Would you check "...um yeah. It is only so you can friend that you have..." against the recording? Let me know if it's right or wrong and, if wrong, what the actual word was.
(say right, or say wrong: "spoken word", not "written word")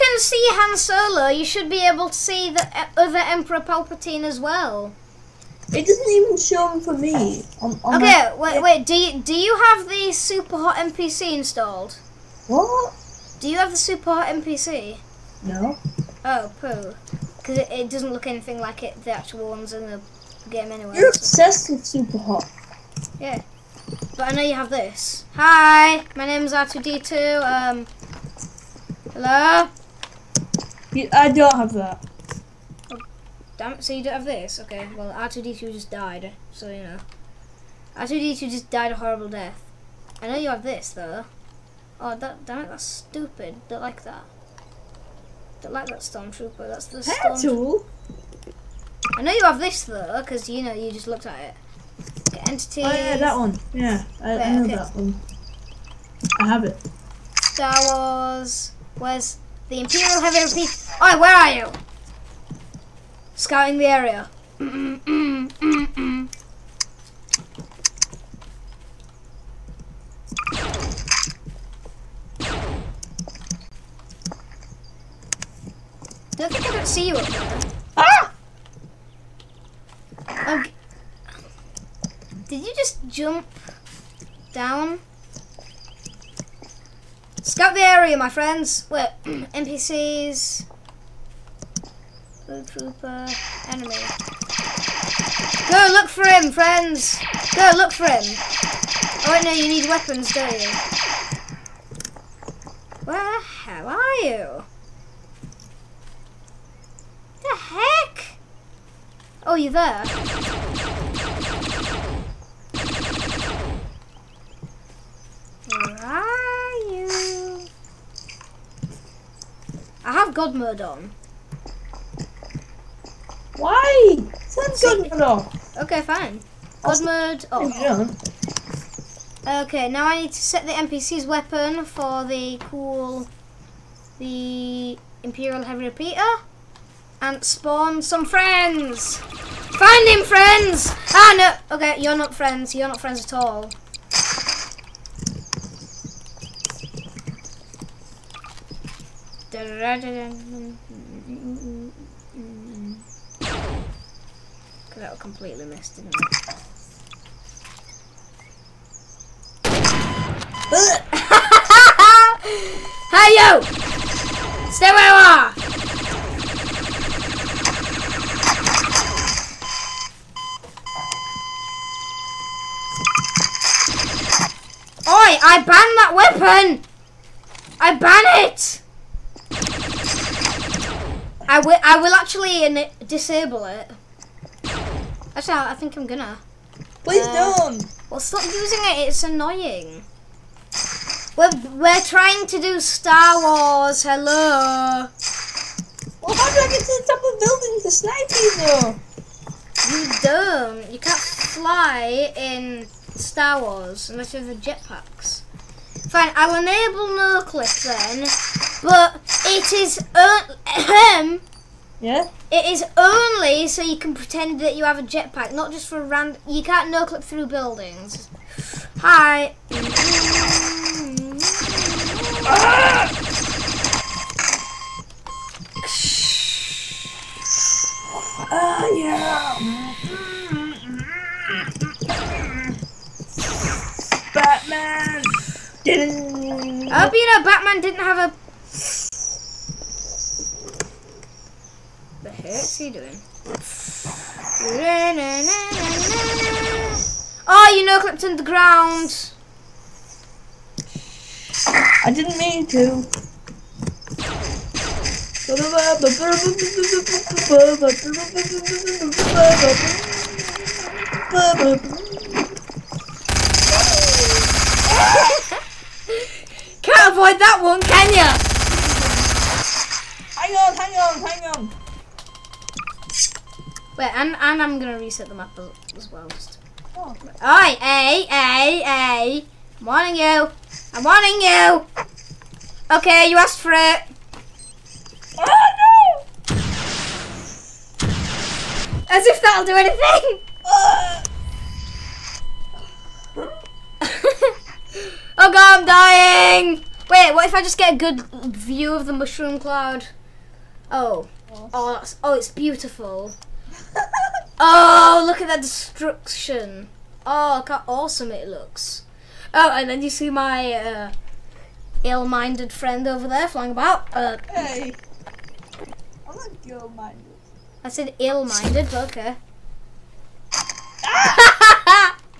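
wrong: "pretend", not "friend".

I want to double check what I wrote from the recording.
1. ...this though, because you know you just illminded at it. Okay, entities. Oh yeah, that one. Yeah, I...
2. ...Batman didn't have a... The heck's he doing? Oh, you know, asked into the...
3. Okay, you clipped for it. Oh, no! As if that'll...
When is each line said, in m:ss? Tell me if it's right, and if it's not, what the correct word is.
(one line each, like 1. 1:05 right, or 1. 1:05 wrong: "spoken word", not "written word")
1. 0:49 wrong: "looked", not "illminded"
2. 3:57 wrong: "clipped", not "asked"
3. 4:42 wrong: "asked", not "clipped".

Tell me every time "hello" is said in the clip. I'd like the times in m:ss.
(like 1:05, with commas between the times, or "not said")
0:29, 3:14.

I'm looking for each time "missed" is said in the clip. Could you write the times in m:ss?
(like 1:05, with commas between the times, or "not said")
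2:35.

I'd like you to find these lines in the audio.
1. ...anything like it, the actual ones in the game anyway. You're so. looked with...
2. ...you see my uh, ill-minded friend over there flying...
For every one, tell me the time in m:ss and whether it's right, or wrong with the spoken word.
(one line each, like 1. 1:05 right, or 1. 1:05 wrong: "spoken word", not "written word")
1. 0:18 wrong: "obsessed", not "looked"
2. 5:10 right.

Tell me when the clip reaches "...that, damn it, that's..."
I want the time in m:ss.
0:42.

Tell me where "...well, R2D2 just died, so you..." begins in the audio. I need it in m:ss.
0:34.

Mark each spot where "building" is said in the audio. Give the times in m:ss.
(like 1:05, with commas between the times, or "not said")
3:18, 3:37.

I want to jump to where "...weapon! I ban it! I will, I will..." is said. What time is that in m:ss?
2:56.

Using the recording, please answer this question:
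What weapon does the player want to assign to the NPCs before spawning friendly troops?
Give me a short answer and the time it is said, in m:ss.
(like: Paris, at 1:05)
Imperial Heavy Repeater, at 2:15.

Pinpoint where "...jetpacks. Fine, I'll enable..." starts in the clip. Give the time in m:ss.
3:24.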